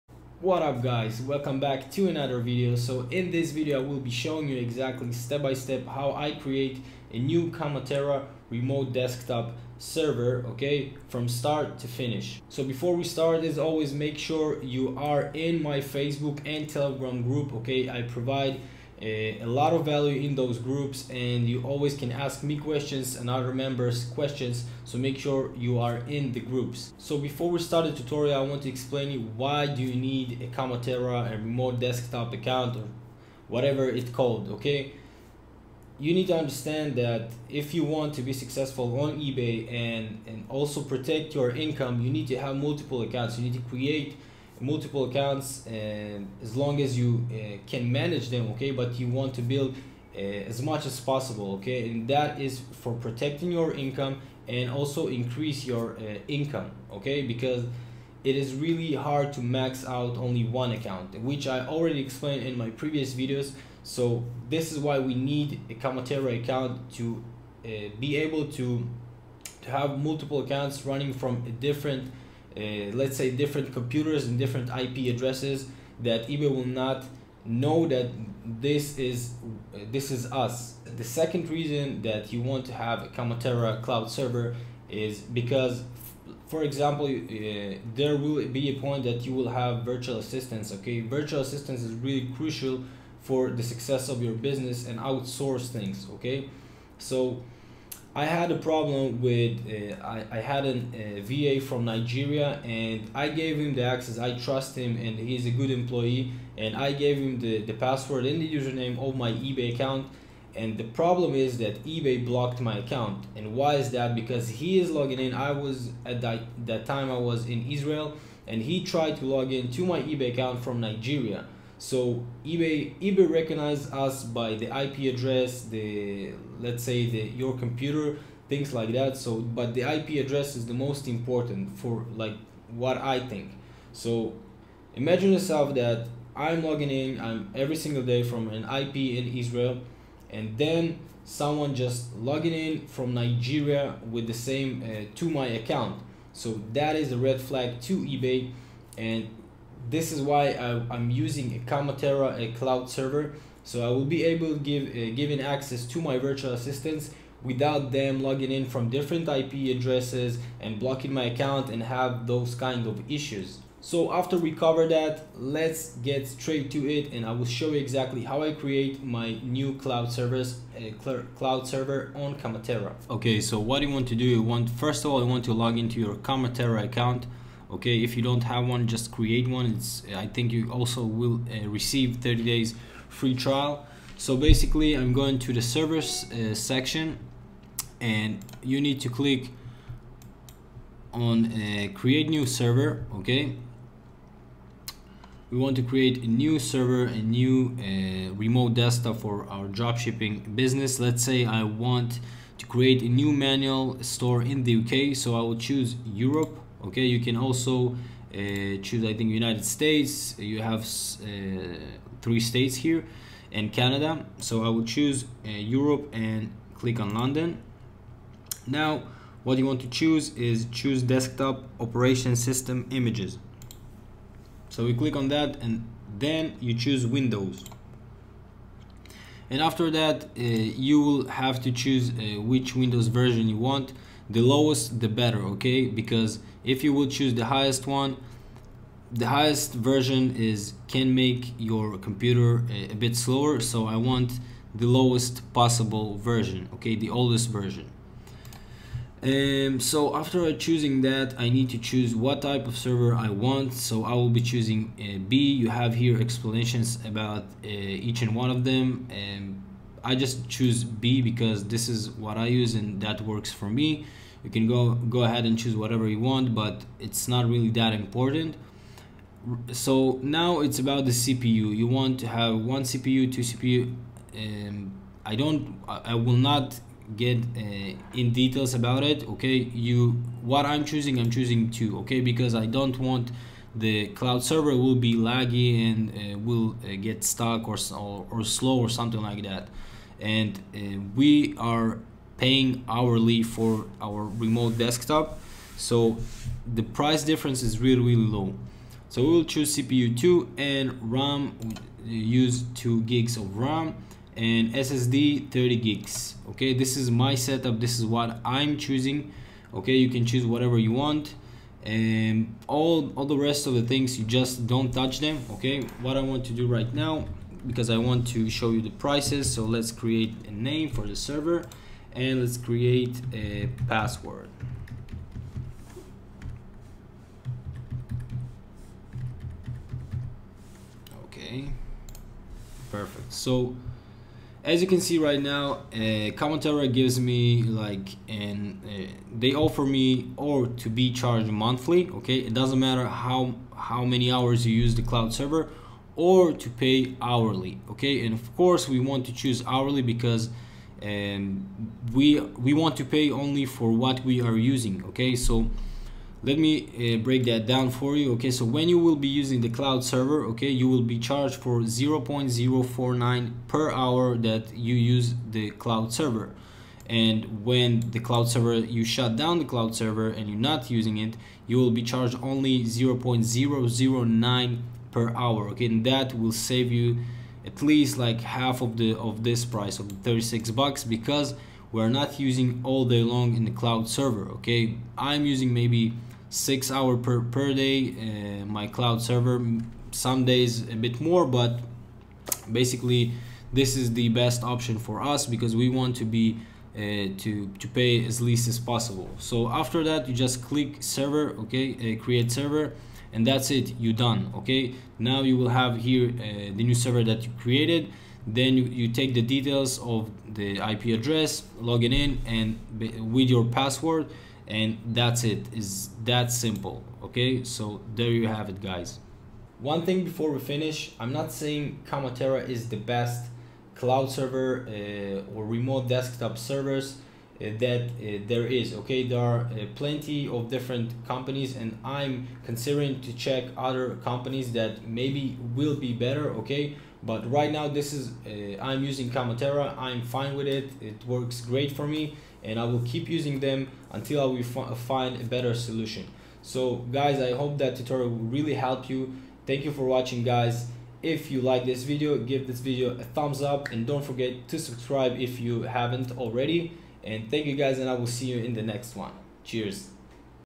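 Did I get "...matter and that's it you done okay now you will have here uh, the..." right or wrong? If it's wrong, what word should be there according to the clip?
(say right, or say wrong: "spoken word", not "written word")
wrong: "server", not "matter".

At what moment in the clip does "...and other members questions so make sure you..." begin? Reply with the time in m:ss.
0:23.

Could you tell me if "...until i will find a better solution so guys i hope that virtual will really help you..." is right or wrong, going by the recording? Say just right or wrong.
wrong.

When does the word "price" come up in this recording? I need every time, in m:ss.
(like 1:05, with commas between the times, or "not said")
4:56, 5:19, 6:19.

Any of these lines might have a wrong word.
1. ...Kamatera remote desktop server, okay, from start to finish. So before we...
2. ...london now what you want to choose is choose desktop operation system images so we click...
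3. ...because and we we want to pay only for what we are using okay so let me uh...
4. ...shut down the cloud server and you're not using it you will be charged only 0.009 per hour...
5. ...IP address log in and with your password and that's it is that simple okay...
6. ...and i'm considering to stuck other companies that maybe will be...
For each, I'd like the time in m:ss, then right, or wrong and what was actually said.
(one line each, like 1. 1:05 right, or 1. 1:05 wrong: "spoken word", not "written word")
1. 0:07 right
2. 3:37 right
3. 5:50 right
4. 6:09 right
5. 6:50 right
6. 7:11 wrong: "check", not "stuck".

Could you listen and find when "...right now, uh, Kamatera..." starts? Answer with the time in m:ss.
5:35.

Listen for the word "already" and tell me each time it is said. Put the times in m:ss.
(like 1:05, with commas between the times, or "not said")
1:01, 7:36.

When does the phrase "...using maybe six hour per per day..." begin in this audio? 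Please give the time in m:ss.
6:25.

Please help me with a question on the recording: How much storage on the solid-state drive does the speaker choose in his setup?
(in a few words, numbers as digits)
30 gigs.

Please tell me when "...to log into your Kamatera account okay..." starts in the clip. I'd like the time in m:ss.
2:55.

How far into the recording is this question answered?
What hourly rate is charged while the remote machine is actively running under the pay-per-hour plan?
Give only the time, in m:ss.
6:01.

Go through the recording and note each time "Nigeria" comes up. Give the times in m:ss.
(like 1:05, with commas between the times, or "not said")
1:41, 2:00, 2:23.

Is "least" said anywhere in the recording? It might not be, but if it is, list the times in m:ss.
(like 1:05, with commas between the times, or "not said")
6:17, 6:38.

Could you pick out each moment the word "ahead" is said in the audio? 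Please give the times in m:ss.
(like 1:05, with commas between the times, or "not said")
4:25.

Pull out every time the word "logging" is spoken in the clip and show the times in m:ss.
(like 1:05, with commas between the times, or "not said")
1:54, 2:16, 2:22, 2:38.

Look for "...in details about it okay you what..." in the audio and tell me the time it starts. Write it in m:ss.
4:38.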